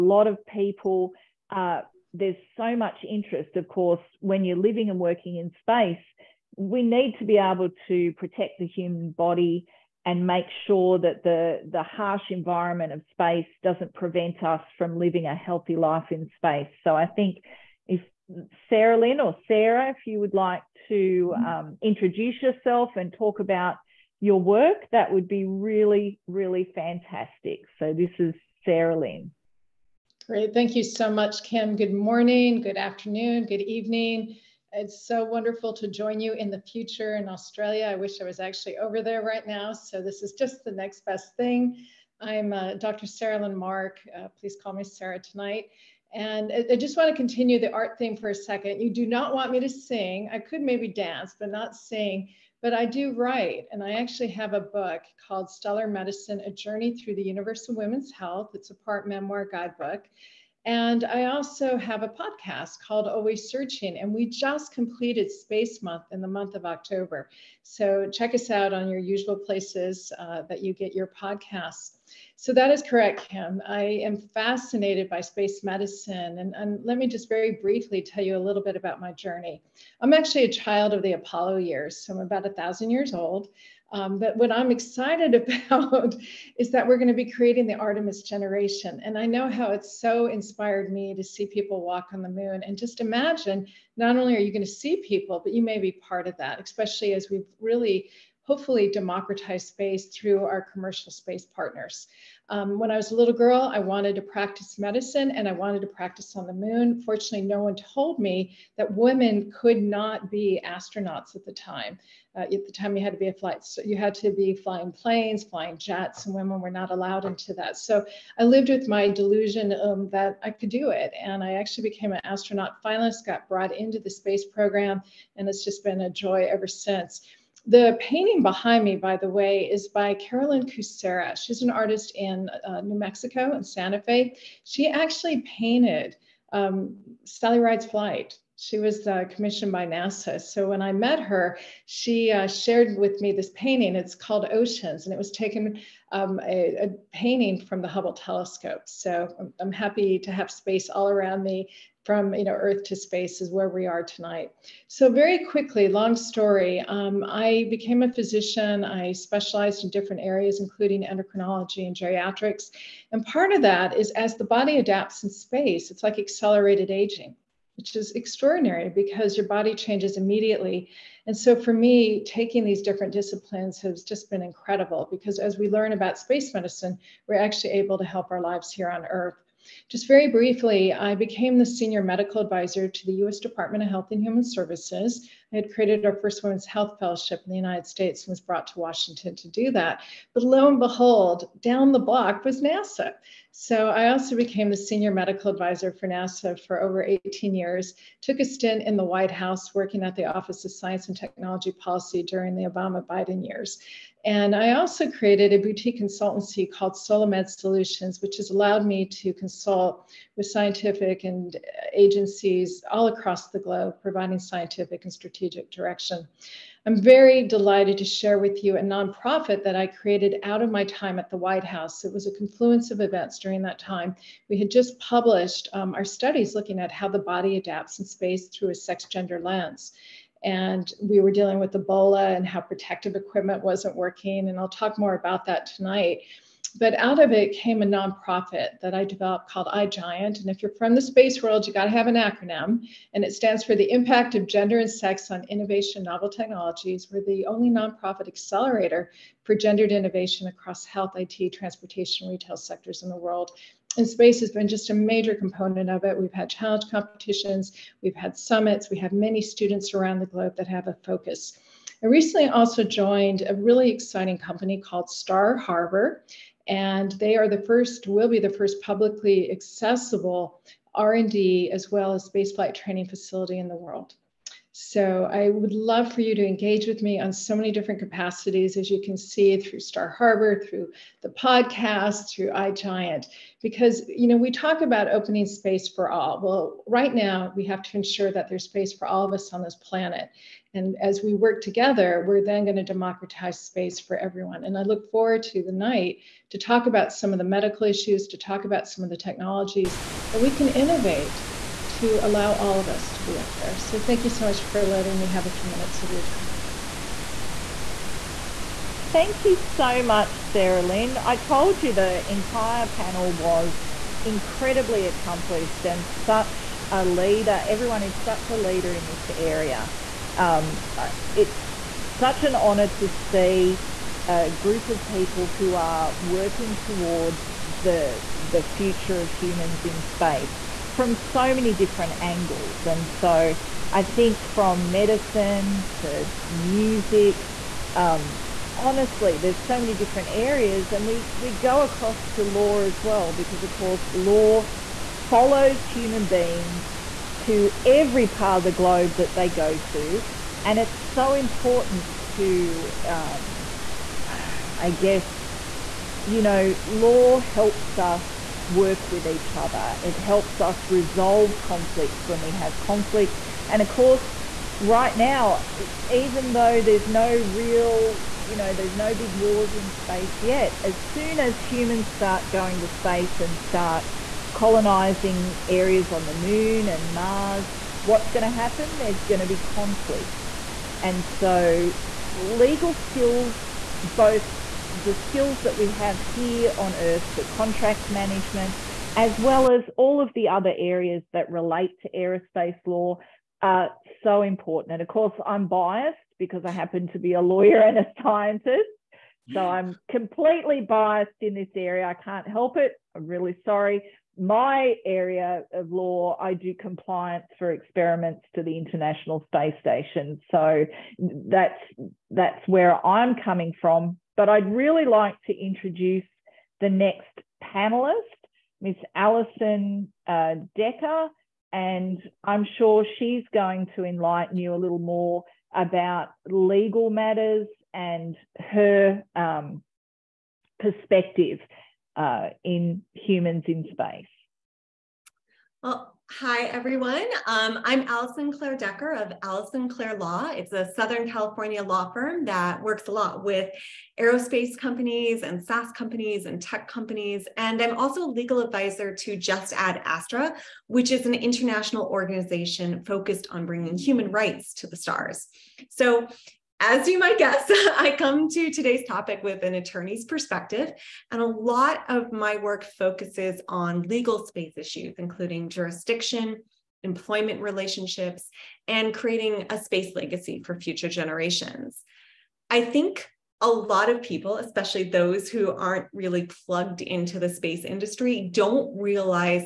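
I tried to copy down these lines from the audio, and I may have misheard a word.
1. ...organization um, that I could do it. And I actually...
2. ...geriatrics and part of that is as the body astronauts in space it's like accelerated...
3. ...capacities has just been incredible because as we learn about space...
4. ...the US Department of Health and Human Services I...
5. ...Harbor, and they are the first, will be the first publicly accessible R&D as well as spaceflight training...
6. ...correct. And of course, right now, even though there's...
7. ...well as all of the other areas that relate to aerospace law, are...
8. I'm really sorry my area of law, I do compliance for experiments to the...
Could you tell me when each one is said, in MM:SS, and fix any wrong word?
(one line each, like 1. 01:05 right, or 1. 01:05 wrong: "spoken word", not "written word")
1. 01:59 wrong: "delusion", not "organization"
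2. 02:41 wrong: "adapts", not "astronauts"
3. 02:53 wrong: "disciplines", not "capacities"
4. 03:03 right
5. 04:25 right
6. 06:02 wrong: "conflict", not "correct"
7. 06:29 right
8. 06:43 right.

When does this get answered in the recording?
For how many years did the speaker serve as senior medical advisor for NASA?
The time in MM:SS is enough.
03:17.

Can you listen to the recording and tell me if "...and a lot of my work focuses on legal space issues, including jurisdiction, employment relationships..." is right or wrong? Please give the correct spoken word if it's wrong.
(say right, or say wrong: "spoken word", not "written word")
right.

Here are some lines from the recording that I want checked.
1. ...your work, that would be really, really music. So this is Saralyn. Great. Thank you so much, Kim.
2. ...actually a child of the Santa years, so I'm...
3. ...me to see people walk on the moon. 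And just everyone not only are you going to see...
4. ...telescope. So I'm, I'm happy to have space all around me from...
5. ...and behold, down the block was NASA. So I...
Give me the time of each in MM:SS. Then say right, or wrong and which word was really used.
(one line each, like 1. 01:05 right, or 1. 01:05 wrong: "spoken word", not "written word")
1. 00:24 wrong: "fantastic", not "music"
2. 01:20 wrong: "Apollo", not "Santa"
3. 01:30 wrong: "imagine", not "everyone"
4. 02:28 right
5. 03:10 right.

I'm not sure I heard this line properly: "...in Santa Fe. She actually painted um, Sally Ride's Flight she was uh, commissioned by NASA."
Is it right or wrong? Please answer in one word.
right.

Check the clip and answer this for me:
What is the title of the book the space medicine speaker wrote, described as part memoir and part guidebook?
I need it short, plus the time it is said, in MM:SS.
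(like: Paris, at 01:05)
Stellar Medicine, at 00:55.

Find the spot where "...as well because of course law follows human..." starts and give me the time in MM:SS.
05:42.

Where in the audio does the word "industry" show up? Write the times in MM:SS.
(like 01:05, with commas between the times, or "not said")
07:57.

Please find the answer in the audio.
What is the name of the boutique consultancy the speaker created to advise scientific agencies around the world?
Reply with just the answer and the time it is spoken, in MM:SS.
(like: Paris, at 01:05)
Solomed Solutions, at 03:26.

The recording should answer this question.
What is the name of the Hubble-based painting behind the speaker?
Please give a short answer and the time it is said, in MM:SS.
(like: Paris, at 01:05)
Oceans, at 02:24.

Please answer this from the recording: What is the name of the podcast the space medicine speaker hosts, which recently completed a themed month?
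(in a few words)
Always Searching.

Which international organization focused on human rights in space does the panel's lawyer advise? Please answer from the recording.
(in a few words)
Just Add Astra.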